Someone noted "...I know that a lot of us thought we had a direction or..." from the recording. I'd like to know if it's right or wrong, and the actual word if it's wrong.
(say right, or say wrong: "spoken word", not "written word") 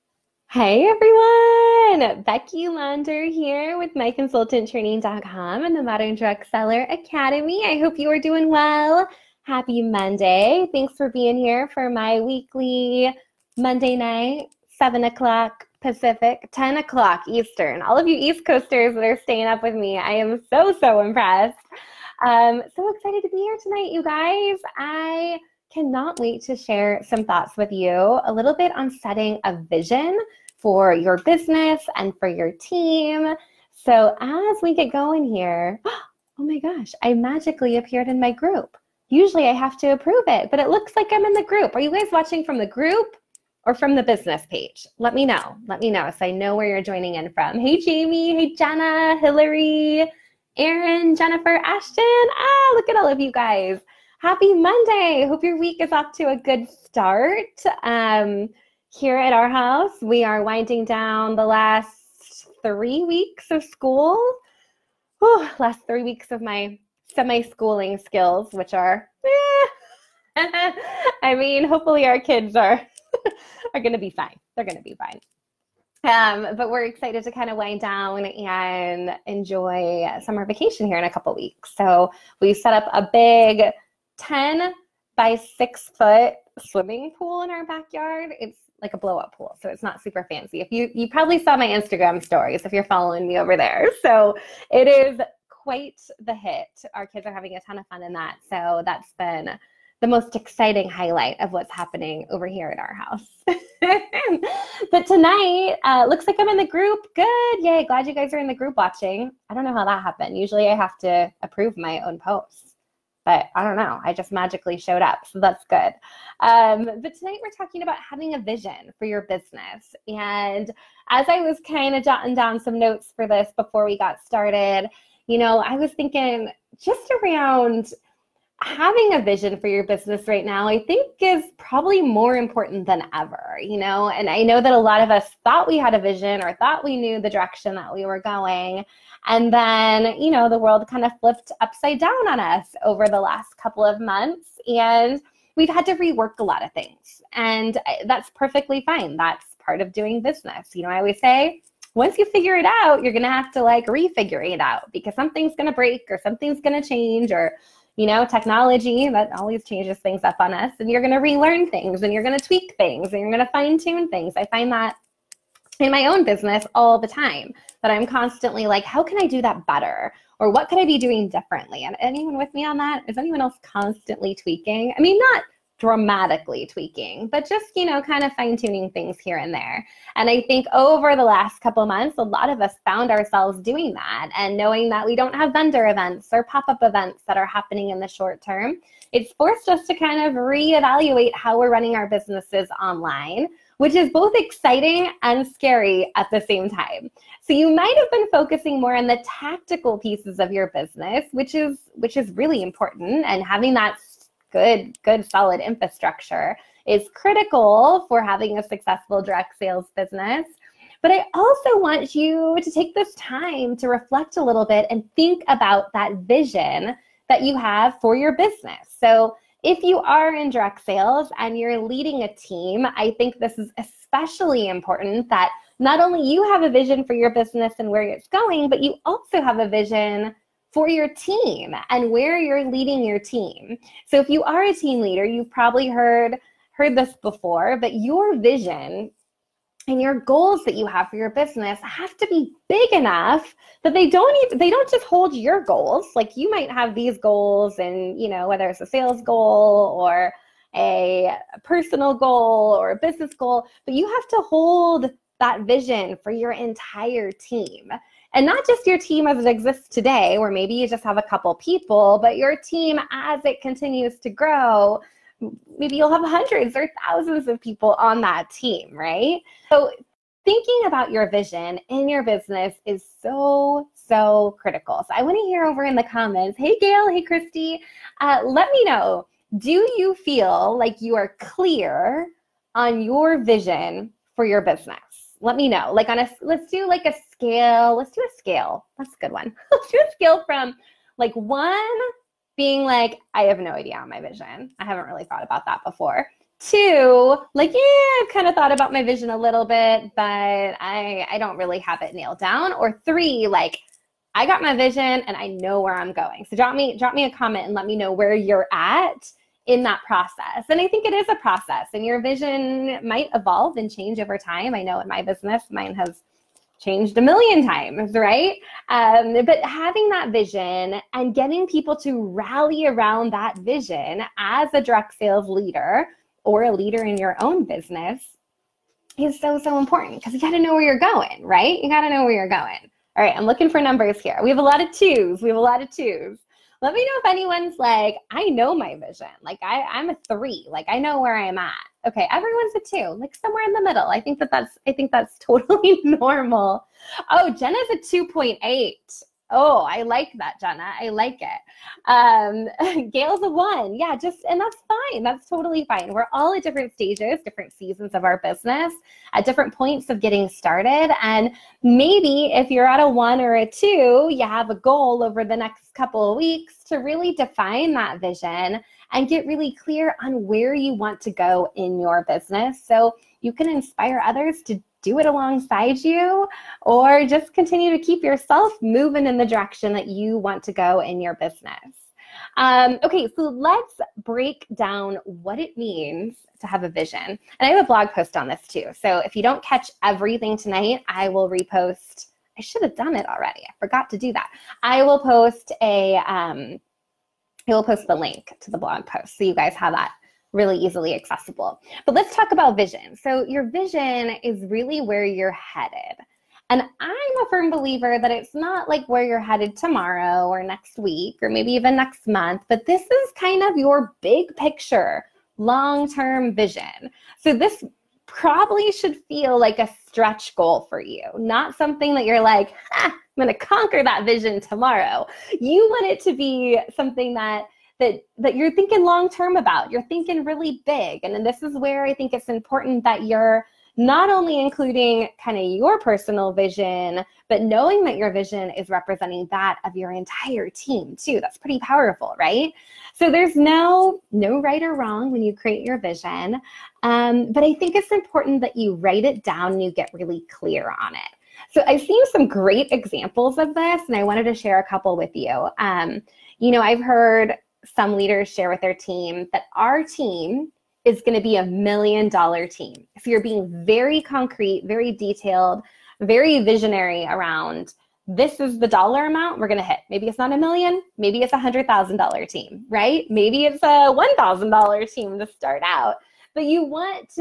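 wrong: "vision", not "direction".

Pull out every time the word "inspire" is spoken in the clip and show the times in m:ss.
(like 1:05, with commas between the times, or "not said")
6:13.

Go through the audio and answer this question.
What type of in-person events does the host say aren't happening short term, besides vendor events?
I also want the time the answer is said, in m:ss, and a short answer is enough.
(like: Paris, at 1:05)
pop up events, at 3:06.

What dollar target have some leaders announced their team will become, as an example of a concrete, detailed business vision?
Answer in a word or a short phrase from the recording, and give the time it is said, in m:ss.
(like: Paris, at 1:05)
$1,000,000, at 7:41.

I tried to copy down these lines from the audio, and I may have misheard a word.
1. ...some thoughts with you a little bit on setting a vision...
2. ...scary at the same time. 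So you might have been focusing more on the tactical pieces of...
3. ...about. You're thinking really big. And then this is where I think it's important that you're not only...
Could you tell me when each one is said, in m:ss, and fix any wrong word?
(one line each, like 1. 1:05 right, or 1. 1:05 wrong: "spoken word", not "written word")
1. 0:27 right
2. 3:15 right
3. 7:09 right.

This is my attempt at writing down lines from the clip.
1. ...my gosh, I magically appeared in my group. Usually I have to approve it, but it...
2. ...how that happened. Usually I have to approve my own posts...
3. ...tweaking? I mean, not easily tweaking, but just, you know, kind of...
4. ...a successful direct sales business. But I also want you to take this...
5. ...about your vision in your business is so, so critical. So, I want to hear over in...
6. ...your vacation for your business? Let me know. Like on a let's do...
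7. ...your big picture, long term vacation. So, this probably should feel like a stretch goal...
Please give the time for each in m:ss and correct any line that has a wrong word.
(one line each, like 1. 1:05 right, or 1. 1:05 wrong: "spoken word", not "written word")
1. 0:36 right
2. 1:49 right
3. 2:54 wrong: "dramatically", not "easily"
4. 3:28 right
5. 4:30 right
6. 4:43 wrong: "vision", not "vacation"
7. 6:53 wrong: "vision", not "vacation".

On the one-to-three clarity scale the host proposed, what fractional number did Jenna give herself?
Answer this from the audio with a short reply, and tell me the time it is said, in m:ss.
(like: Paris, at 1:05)
2.8, at 5:47.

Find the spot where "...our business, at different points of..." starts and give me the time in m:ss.
5:58.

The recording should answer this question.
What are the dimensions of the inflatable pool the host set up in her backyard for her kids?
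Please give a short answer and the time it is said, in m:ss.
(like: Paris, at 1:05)
10 by 6 foot, at 1:24.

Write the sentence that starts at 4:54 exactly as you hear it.
I haven't really thought about that before.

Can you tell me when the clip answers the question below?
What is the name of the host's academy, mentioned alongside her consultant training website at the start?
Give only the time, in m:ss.
0:05.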